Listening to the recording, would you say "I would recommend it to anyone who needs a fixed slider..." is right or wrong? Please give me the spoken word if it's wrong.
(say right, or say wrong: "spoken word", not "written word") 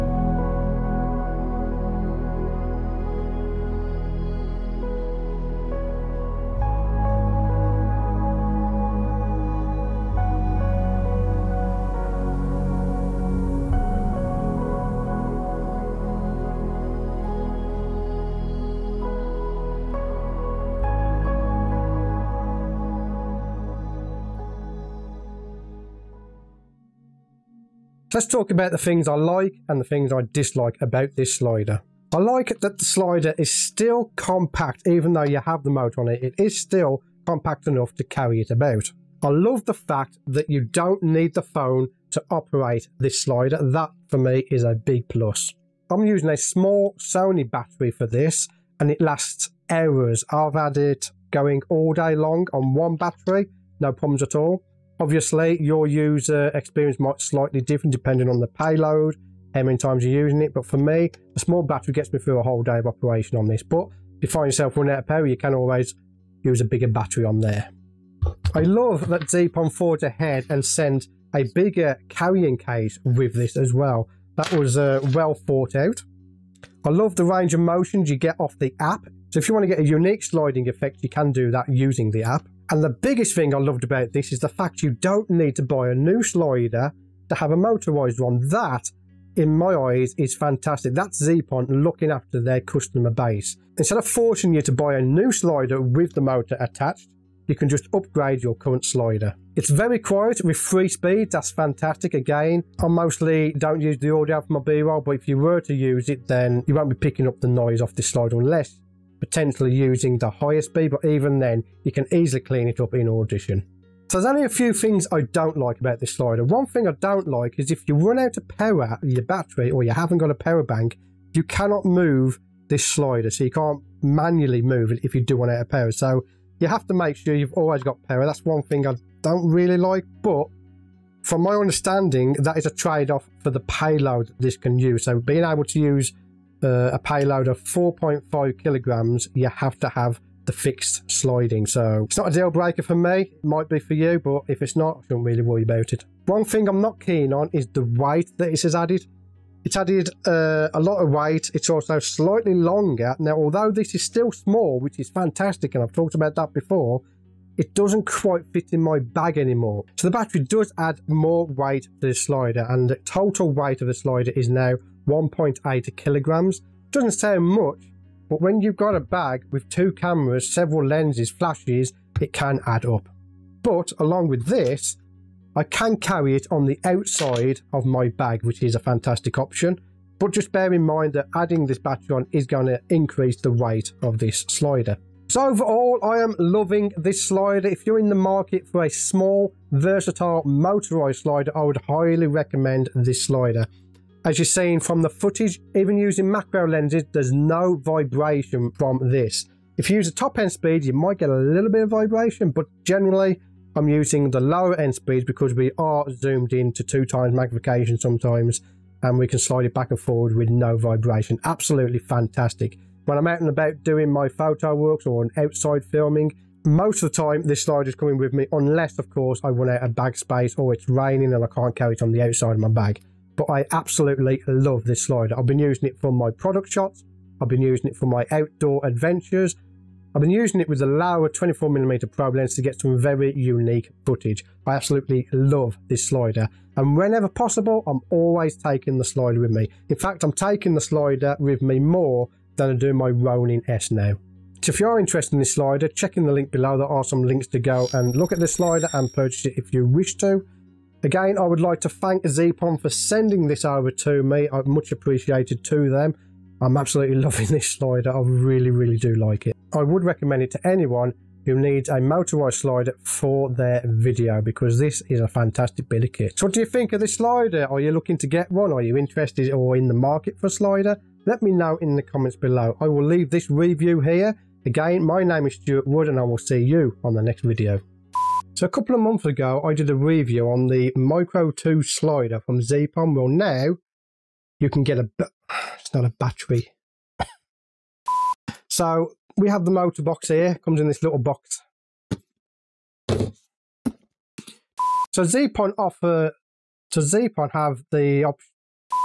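wrong: "motorized", not "fixed".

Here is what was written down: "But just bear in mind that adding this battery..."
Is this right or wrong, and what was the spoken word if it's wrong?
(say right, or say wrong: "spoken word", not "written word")
right.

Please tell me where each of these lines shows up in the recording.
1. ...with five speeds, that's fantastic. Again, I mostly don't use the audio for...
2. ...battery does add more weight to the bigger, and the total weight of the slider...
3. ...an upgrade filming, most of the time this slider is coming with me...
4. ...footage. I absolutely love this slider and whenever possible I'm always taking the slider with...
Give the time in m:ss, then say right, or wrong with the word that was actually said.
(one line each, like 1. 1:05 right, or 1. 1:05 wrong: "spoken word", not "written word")
1. 1:40 wrong: "three", not "five"
2. 2:40 wrong: "slider", not "bigger"
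3. 3:35 wrong: "outside", not "upgrade"
4. 3:54 right.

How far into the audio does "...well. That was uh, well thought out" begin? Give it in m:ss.
1:13.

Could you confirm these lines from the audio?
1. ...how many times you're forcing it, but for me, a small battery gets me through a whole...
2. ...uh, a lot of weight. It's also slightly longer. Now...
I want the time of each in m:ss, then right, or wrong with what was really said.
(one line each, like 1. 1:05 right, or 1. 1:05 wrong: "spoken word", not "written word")
1. 0:59 wrong: "using", not "forcing"
2. 2:30 right.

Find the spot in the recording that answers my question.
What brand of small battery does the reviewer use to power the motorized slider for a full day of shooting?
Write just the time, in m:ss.
0:46.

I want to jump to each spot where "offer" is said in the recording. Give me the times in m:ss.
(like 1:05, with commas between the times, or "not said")
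4:55.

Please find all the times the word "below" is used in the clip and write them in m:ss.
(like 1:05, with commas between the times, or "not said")
4:06, 4:32.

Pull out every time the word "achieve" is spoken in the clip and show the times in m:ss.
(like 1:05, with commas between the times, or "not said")
not said.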